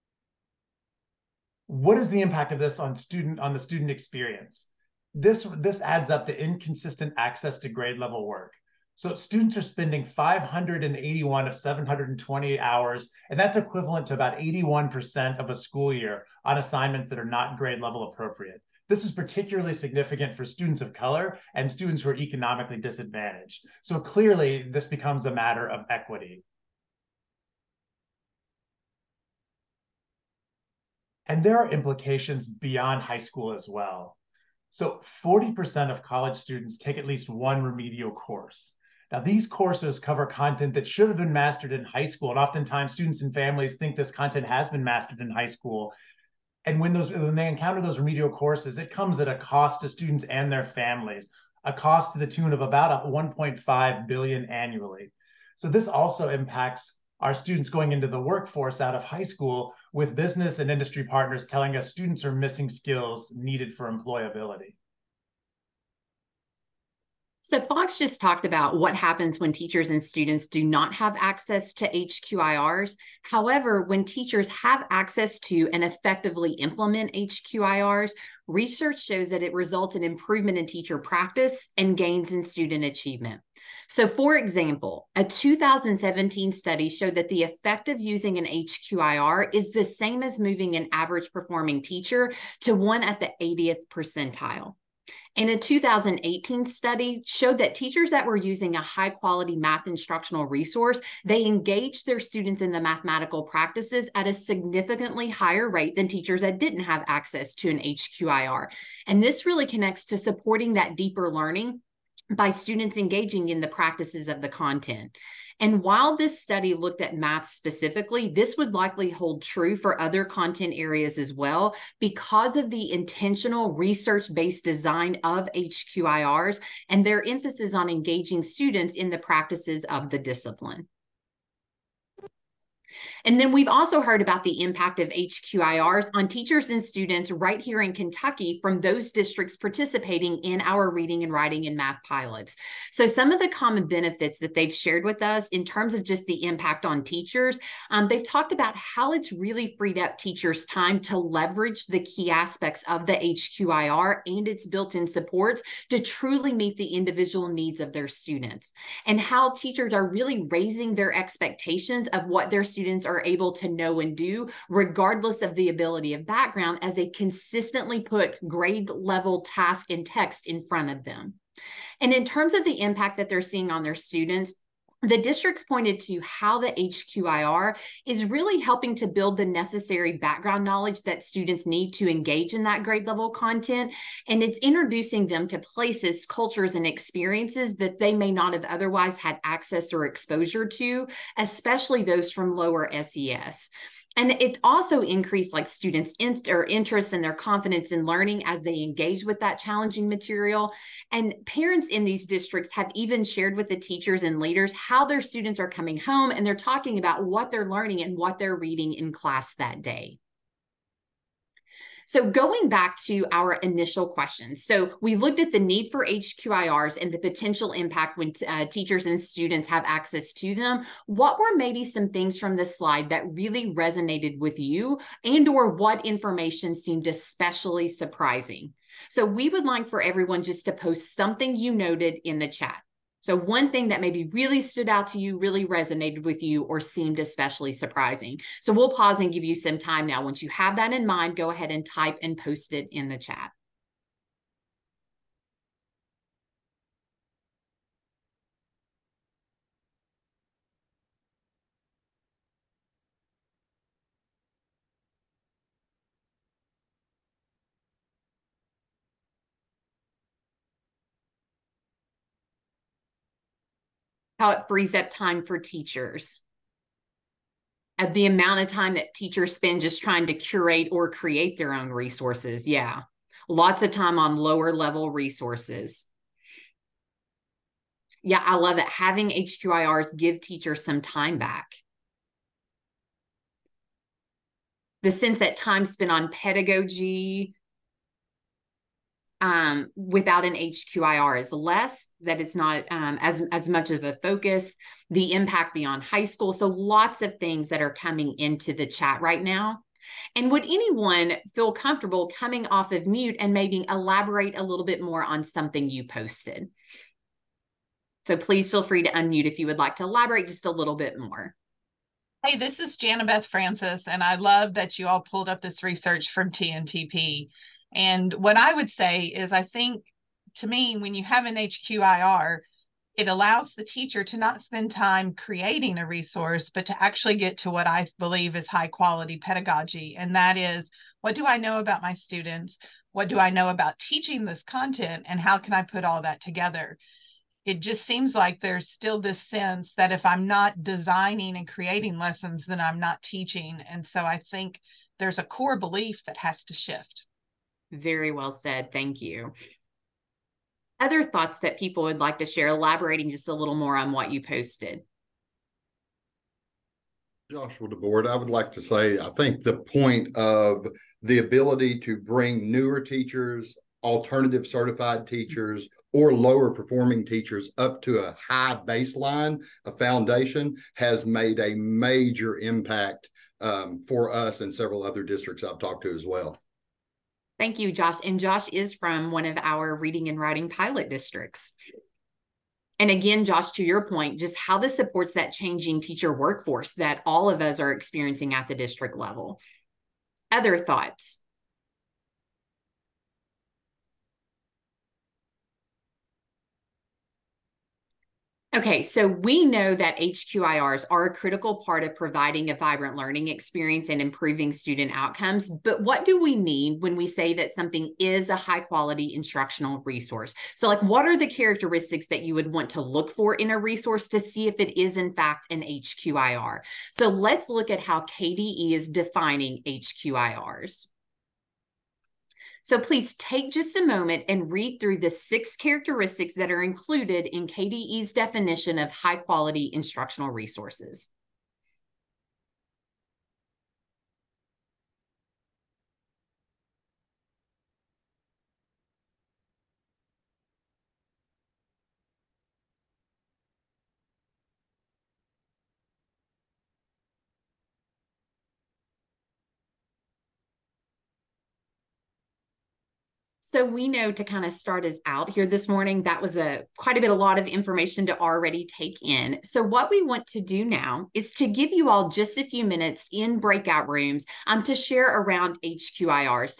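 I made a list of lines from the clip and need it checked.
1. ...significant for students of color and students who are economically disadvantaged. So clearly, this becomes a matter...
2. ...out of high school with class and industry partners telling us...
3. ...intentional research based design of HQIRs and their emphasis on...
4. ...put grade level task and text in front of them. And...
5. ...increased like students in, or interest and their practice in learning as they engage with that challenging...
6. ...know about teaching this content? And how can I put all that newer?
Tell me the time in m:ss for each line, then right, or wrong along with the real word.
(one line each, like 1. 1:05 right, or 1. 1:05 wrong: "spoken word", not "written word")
1. 0:19 right
2. 0:58 wrong: "business", not "class"
3. 2:02 right
4. 2:48 right
5. 3:15 wrong: "confidence", not "practice"
6. 5:33 wrong: "together", not "newer".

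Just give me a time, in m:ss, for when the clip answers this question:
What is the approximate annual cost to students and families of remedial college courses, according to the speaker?
0:53.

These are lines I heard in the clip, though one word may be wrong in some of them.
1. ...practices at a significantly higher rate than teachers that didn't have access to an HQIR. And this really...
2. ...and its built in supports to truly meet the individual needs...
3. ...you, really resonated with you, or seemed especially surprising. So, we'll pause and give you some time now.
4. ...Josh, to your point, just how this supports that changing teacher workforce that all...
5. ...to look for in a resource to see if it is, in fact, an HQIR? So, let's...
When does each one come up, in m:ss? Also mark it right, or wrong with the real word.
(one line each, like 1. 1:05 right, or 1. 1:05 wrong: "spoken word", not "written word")
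1. 1:43 right
2. 2:34 right
3. 3:55 right
4. 6:23 right
5. 6:52 right.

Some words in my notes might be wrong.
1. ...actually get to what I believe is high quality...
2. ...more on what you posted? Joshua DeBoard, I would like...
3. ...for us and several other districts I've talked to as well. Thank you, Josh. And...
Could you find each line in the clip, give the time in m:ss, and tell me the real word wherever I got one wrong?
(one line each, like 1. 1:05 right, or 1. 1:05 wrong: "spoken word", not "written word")
1. 5:27 right
2. 5:53 right
3. 6:14 right.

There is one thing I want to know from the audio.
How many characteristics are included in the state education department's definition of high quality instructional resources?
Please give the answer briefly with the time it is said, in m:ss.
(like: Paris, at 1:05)
6, at 7:05.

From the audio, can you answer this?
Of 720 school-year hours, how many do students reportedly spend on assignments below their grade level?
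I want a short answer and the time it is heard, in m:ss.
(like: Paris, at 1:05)
581, at 0:10.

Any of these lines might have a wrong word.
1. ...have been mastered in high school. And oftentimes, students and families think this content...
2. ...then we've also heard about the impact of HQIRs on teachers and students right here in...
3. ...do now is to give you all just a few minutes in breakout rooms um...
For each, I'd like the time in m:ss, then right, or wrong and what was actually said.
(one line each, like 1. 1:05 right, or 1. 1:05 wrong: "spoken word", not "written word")
1. 0:41 right
2. 2:13 right
3. 7:40 right.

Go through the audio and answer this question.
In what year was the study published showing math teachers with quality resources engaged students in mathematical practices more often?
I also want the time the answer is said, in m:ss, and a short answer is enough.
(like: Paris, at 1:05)
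2018, at 1:35.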